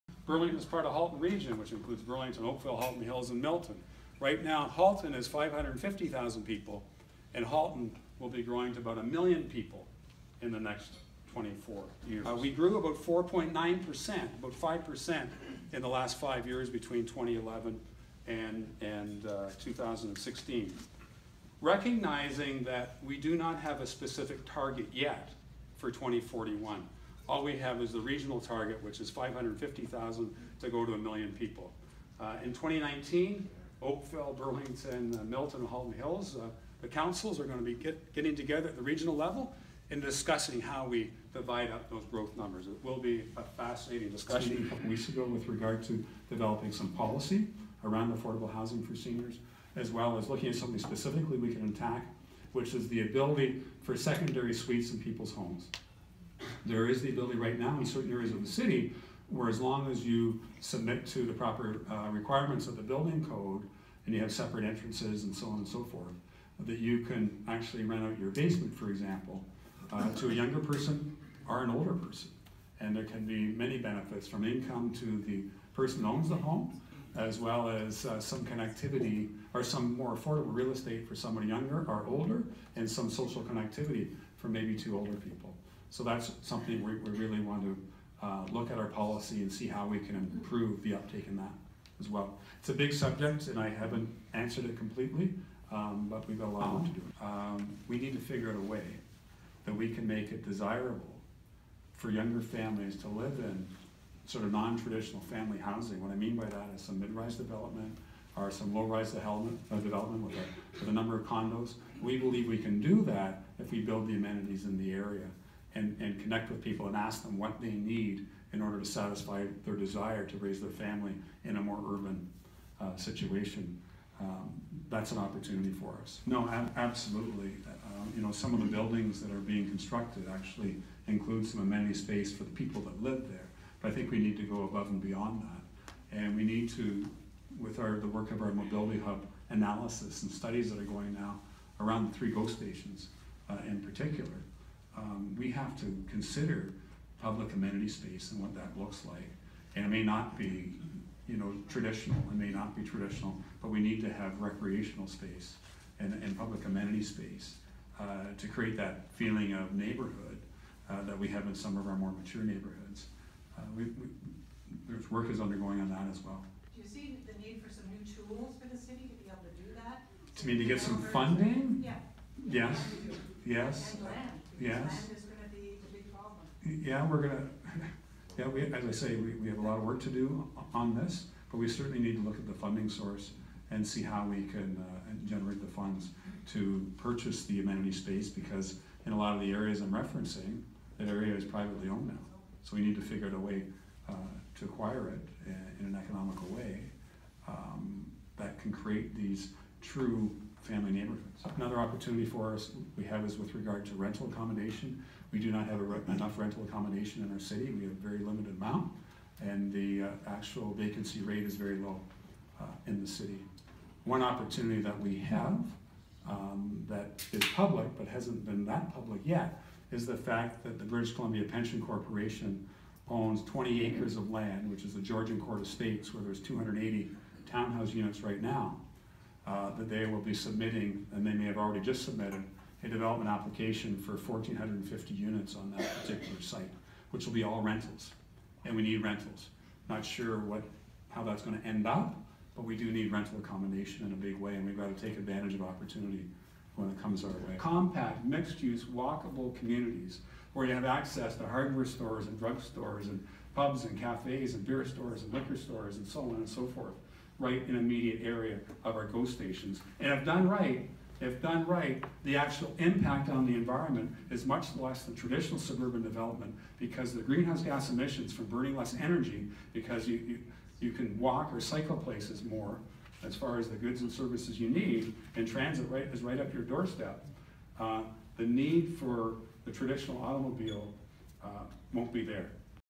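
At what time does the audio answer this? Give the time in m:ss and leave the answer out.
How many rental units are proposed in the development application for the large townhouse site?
3:54.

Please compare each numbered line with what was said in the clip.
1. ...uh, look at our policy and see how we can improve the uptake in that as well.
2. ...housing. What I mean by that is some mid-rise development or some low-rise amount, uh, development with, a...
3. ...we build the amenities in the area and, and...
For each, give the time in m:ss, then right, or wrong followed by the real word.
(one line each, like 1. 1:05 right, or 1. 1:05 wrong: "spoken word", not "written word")
1. 1:28 right
2. 1:45 wrong: "development", not "amount"
3. 1:53 right.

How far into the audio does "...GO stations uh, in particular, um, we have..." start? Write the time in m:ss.
2:22.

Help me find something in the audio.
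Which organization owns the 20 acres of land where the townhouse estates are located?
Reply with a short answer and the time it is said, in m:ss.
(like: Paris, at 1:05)
British Columbia Pension Corporation, at 3:40.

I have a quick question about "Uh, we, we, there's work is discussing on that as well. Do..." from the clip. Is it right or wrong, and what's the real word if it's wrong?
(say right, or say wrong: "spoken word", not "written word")
wrong: "undergoing", not "discussing".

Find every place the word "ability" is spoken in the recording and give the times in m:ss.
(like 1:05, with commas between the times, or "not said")
0:53, 0:57.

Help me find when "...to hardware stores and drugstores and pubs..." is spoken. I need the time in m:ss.
4:11.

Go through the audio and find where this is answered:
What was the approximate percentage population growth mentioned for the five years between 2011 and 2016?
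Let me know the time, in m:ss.
0:12.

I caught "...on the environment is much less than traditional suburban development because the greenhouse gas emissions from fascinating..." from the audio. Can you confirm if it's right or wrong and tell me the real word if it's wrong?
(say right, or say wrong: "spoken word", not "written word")
wrong: "burning", not "fascinating".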